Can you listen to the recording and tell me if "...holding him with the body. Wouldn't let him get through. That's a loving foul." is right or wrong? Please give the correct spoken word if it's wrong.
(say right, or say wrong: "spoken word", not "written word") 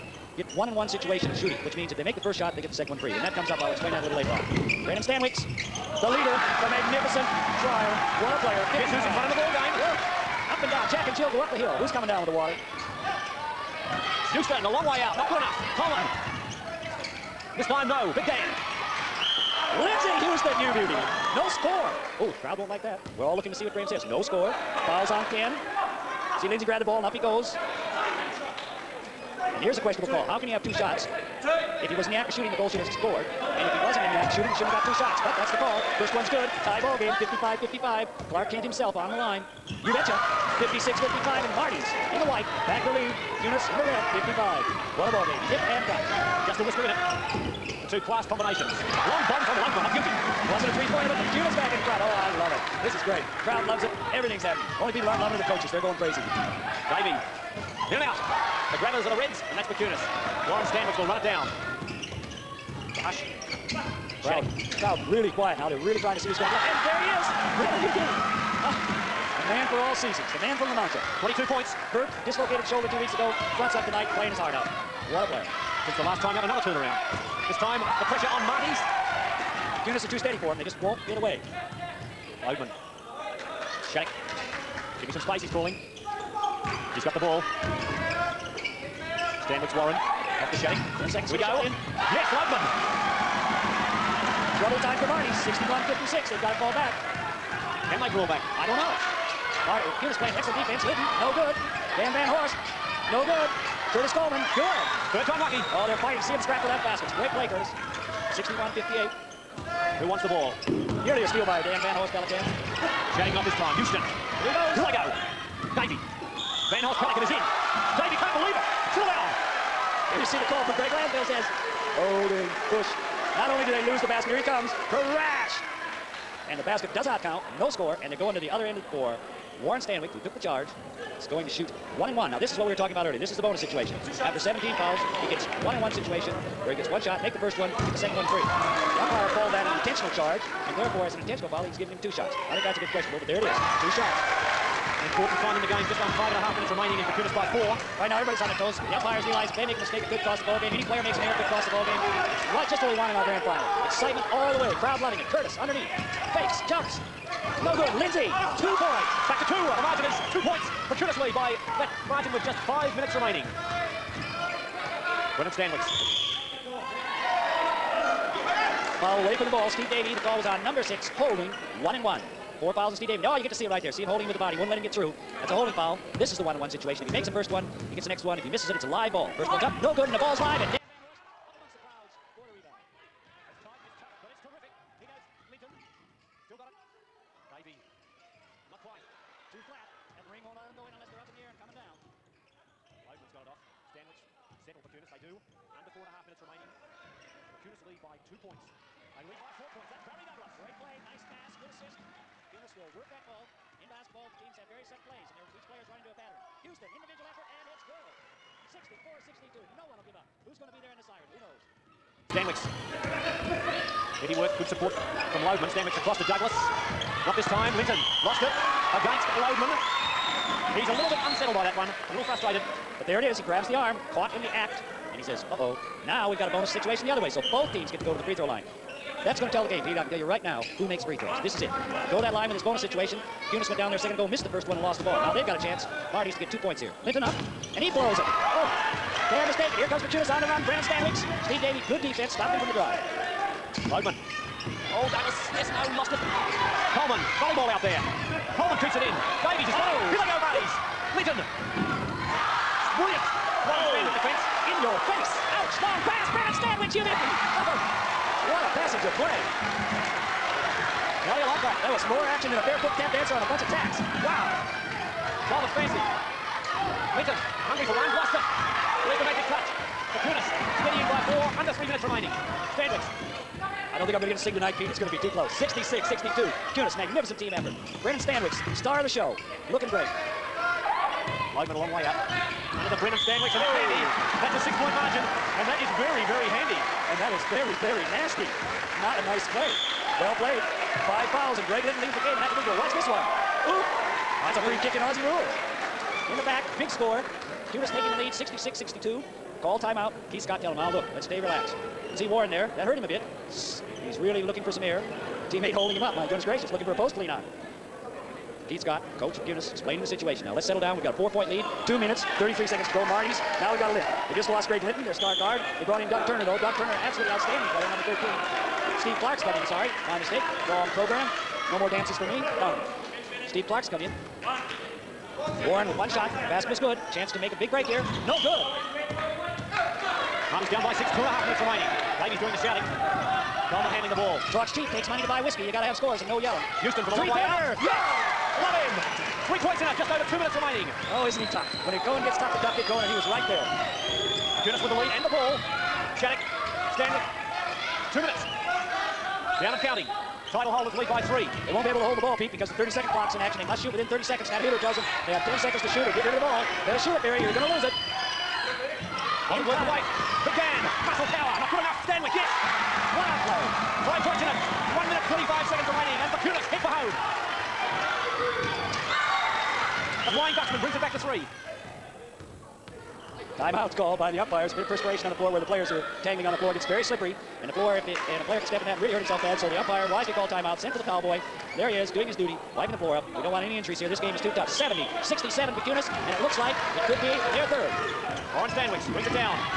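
wrong: "holding", not "loving".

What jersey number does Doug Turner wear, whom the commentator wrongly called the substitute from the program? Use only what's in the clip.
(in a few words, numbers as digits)
13.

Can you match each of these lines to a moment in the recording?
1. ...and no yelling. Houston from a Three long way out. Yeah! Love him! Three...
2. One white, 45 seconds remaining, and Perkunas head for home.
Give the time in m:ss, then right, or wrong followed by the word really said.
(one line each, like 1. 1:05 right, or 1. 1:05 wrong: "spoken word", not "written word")
1. 5:36 right
2. 6:04 wrong: "minute", not "white".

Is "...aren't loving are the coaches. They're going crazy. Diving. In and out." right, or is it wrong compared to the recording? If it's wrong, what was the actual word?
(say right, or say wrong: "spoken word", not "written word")
right.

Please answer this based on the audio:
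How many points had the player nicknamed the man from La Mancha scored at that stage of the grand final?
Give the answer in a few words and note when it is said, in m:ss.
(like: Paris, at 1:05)
22, at 1:11.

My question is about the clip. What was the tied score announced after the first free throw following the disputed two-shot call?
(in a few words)
55-55.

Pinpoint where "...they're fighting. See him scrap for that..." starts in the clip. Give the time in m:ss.
1:45.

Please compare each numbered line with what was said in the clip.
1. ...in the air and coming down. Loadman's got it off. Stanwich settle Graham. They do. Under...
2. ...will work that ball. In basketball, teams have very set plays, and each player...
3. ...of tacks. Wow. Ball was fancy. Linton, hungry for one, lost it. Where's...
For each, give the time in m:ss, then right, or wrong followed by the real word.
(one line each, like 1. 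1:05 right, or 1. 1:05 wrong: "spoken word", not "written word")
1. 3:11 wrong: "Perkunas", not "Graham"
2. 3:22 right
3. 4:23 right.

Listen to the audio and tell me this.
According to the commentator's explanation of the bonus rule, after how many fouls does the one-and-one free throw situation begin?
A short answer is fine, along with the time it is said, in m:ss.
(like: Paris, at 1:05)
17, at 2:14.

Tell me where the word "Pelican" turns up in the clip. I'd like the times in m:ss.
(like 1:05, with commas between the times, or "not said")
1:52, 1:56.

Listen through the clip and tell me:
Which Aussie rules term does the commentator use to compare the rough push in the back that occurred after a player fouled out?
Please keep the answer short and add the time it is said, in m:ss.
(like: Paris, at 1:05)
free kick, at 4:54.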